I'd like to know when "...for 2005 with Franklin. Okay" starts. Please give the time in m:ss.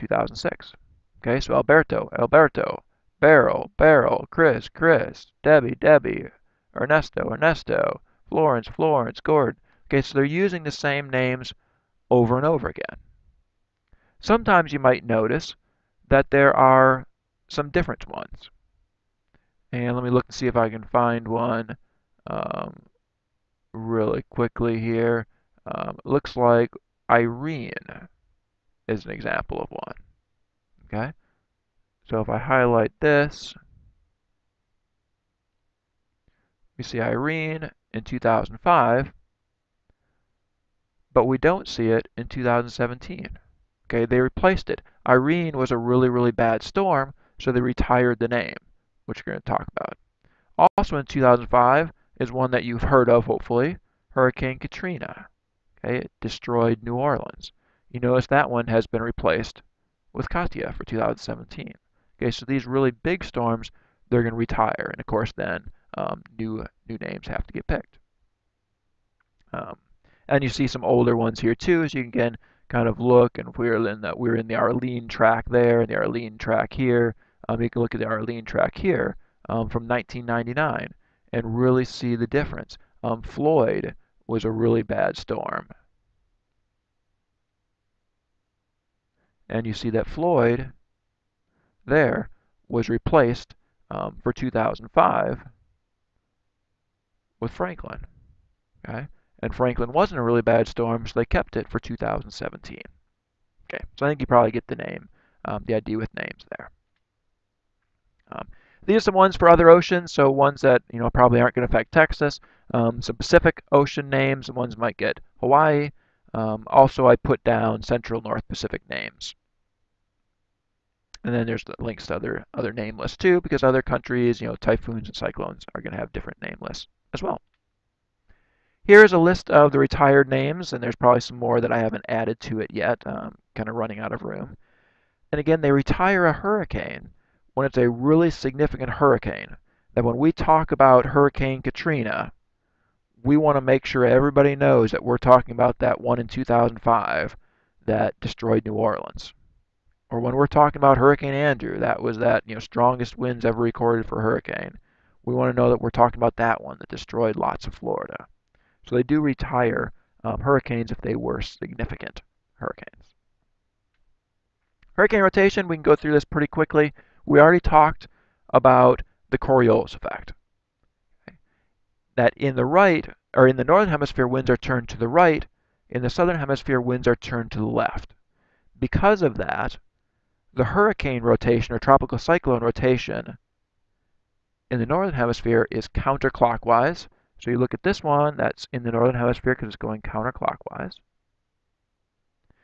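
1:34.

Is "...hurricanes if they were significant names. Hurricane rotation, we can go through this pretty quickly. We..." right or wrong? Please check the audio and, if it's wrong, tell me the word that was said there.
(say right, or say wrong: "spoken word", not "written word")
wrong: "hurricanes", not "names".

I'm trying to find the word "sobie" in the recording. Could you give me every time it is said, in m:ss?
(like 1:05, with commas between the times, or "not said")
not said.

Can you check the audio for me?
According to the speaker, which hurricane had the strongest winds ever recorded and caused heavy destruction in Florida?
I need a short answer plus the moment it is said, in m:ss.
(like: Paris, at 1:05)
Hurricane Andrew, at 2:30.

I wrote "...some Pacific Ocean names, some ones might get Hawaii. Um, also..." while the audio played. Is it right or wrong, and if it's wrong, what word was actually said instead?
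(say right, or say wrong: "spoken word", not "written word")
right.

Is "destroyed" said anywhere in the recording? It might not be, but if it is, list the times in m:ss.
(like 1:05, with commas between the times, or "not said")
0:56, 2:28, 2:36.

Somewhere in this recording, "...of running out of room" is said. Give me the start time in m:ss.
2:13.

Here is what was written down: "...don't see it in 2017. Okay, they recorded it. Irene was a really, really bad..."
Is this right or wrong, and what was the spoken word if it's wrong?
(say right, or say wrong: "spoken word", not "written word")
wrong: "replaced", not "recorded".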